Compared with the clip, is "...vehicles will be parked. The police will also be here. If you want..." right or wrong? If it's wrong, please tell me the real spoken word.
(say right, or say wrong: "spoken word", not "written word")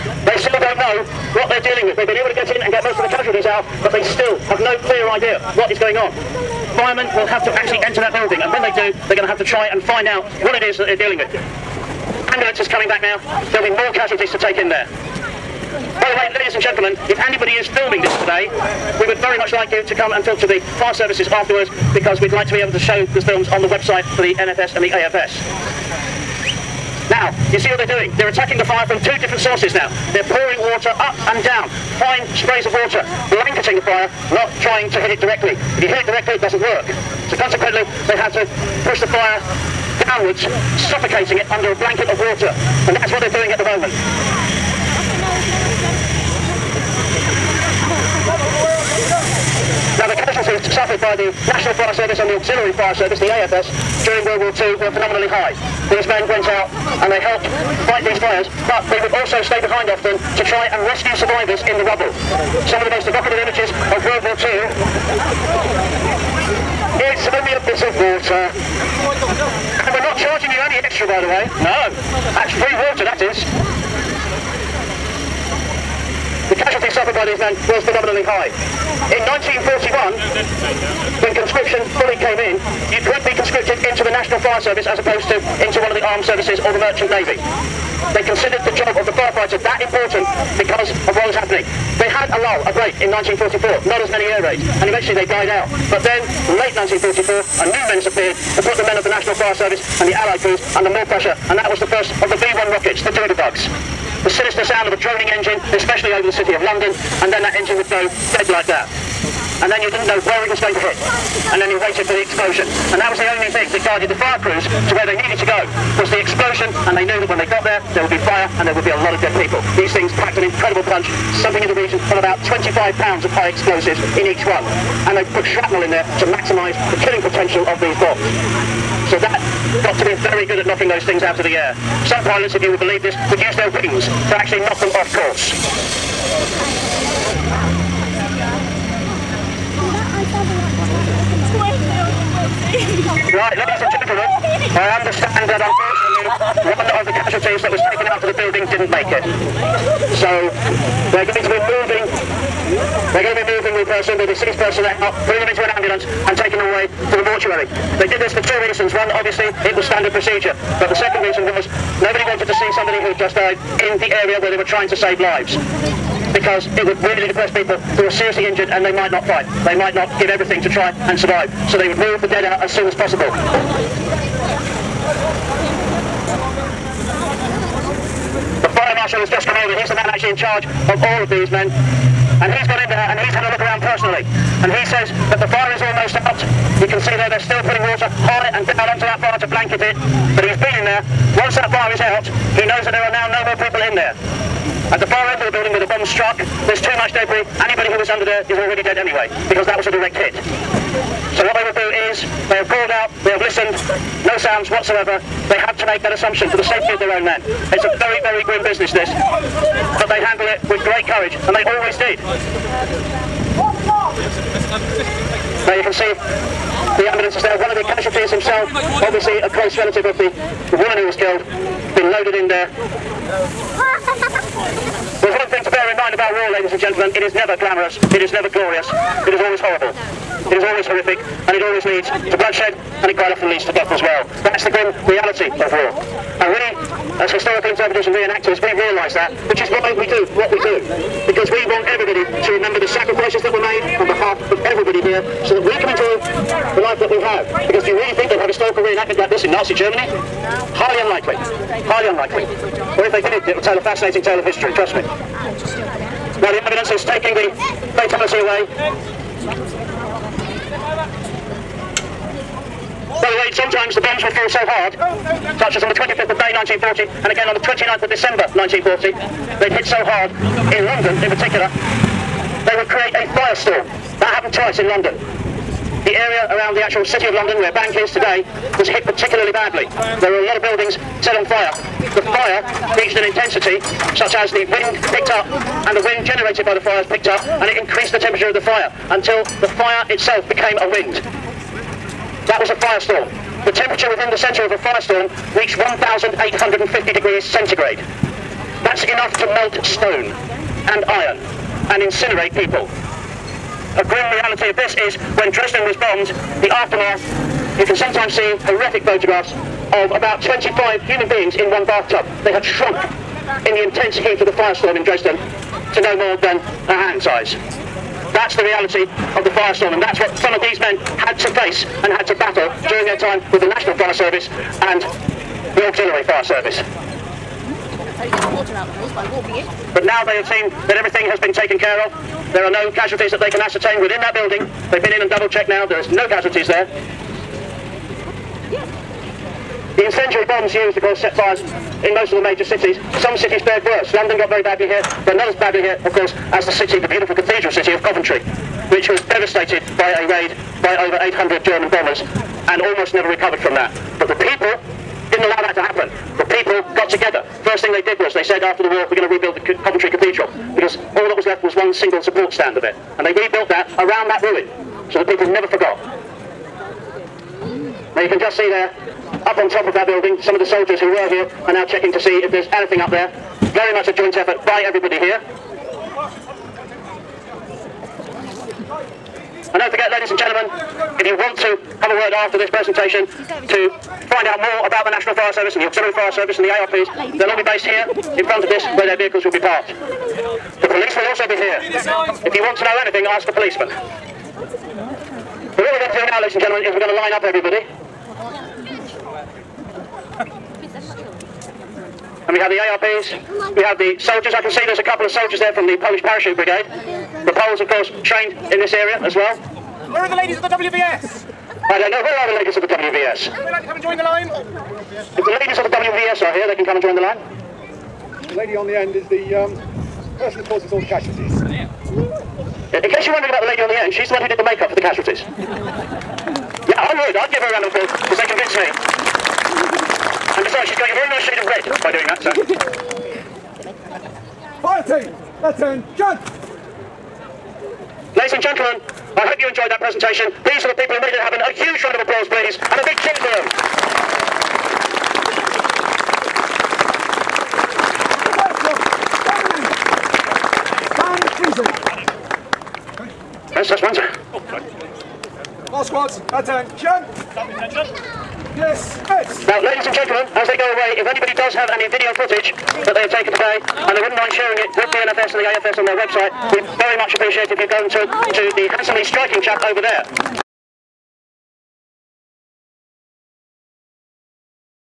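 right.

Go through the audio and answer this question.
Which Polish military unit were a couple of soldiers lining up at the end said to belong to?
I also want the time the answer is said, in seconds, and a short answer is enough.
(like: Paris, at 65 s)
Polish Parachute Brigade, at 405 s.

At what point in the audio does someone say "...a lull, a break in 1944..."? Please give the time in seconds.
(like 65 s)
92 s.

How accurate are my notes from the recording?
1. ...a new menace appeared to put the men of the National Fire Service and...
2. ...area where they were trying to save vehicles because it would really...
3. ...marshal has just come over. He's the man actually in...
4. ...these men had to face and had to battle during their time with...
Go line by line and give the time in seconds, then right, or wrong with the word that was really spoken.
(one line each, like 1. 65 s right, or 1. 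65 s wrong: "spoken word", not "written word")
1. 97 s right
2. 164 s wrong: "lives", not "vehicles"
3. 178 s right
4. 320 s right.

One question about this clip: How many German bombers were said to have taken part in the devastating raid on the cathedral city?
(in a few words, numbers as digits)
over 800.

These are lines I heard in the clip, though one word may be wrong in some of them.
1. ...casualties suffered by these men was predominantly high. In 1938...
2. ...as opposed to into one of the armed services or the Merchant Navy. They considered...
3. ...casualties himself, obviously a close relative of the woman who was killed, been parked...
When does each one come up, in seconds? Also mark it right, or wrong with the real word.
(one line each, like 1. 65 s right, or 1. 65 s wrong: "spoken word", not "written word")
1. 76 s wrong: "1941", not "1938"
2. 84 s right
3. 217 s wrong: "loaded", not "parked".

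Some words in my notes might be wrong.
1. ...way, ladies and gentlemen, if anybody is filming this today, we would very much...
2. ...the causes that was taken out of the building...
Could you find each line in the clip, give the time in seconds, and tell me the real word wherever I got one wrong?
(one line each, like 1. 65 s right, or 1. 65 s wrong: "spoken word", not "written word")
1. 16 s right
2. 147 s wrong: "casualties", not "causes".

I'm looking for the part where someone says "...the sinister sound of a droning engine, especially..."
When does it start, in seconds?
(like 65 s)
104 s.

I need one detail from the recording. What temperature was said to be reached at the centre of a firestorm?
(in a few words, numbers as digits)
1,850 degrees centigrade.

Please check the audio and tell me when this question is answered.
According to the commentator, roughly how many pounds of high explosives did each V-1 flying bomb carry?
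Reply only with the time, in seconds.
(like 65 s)
122 s.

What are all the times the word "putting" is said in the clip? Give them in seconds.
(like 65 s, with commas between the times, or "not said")
155 s, 187 s.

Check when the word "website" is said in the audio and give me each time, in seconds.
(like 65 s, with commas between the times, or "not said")
23 s, 466 s.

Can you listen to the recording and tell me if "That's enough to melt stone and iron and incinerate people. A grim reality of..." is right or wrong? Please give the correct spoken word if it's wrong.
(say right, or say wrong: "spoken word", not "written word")
right.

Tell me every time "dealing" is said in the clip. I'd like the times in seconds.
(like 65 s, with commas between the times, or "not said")
1 s, 10 s.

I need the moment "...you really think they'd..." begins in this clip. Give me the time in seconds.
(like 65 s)
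247 s.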